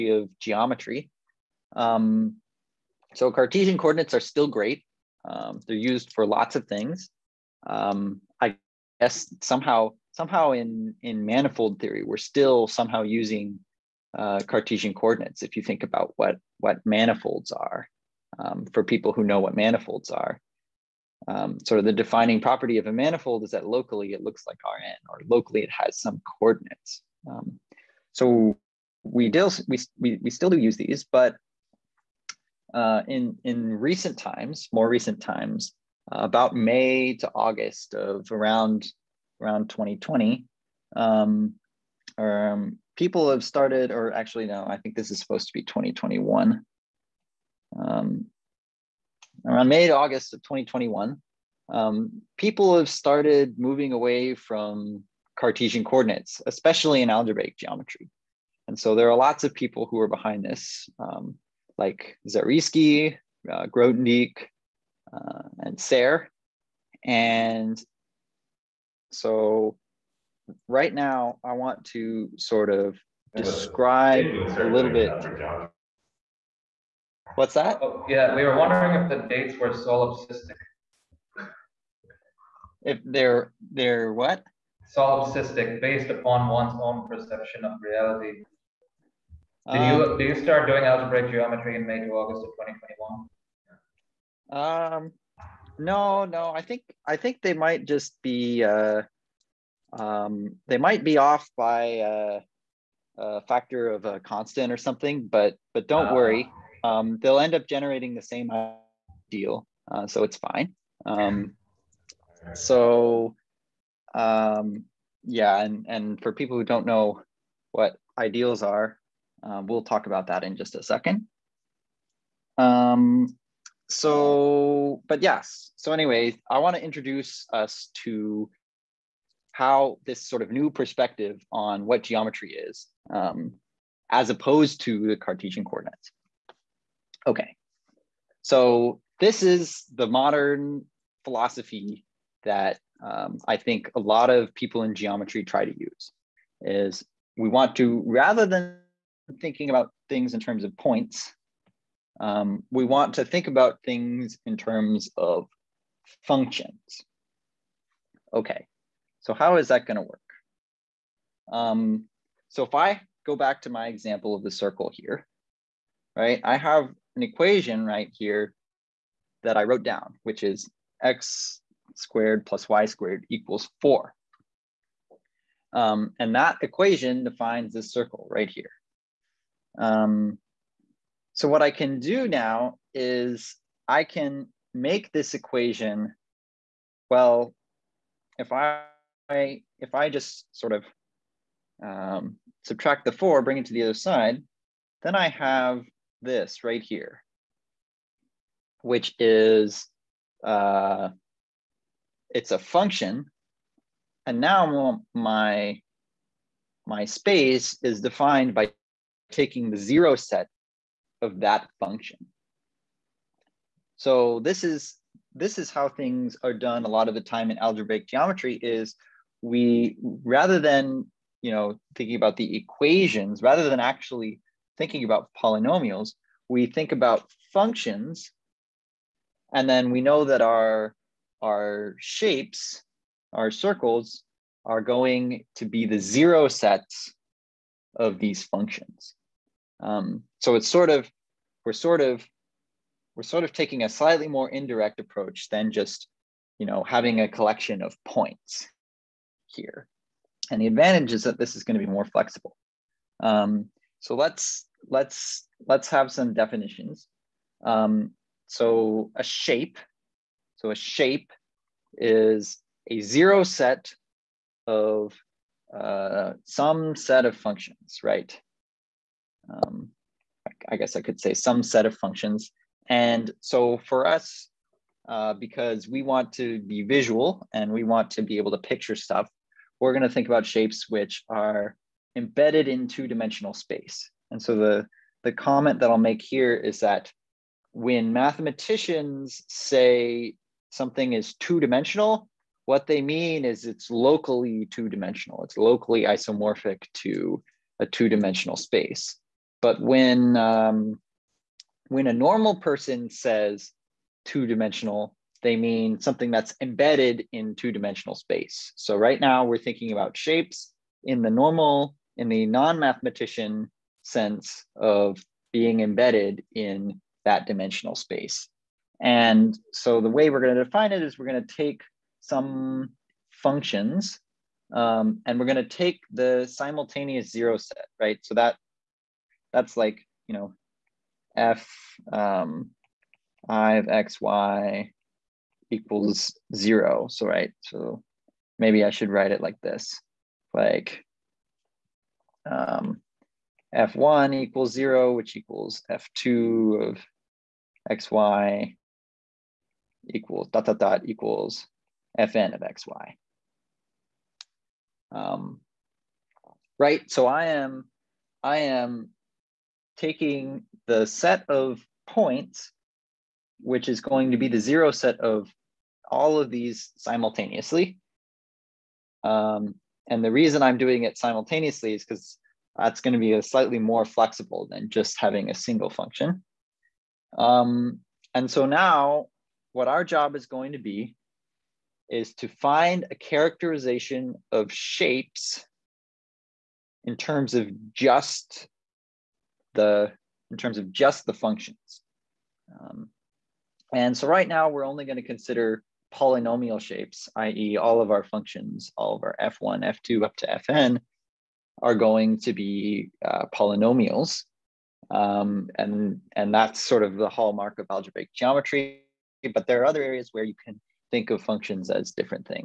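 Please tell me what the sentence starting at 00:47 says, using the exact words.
Um, around May to August of 2021, um, people have started moving away from Cartesian coordinates, especially in algebraic geometry.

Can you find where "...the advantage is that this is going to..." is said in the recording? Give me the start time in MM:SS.
04:10.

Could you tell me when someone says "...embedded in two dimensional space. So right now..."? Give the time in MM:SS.
05:06.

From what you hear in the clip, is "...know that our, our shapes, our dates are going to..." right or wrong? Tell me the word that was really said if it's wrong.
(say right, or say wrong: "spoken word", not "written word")
wrong: "circles", not "dates".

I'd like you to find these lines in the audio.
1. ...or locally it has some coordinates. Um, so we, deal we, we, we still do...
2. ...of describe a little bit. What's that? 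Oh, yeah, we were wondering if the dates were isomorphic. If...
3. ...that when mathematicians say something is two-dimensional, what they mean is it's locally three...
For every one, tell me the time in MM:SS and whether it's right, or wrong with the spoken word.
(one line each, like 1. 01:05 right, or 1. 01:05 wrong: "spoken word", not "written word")
1. 00:25 right
2. 01:12 wrong: "solipsistic", not "isomorphic"
3. 04:46 wrong: "two", not "three".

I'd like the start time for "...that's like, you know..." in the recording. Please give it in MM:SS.
05:29.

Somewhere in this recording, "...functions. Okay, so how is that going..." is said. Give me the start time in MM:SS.
02:36.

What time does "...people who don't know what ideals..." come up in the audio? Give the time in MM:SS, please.
01:56.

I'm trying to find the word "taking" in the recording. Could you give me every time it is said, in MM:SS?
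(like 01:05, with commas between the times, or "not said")
03:29, 04:03, 05:59.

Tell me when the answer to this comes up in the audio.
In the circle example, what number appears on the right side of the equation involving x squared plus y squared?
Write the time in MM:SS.
02:53.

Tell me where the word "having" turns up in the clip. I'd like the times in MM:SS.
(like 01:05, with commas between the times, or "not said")
04:06, 06:15.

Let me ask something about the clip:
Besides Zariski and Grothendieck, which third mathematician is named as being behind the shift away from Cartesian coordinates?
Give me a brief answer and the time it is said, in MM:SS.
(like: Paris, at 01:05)
Serre, at 01:05.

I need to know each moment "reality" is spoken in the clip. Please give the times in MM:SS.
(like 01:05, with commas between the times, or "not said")
01:27.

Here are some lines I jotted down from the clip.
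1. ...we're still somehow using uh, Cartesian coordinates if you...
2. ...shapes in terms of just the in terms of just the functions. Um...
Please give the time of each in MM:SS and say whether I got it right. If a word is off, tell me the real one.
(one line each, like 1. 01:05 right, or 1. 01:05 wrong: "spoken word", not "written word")
1. 00:12 right
2. 06:24 right.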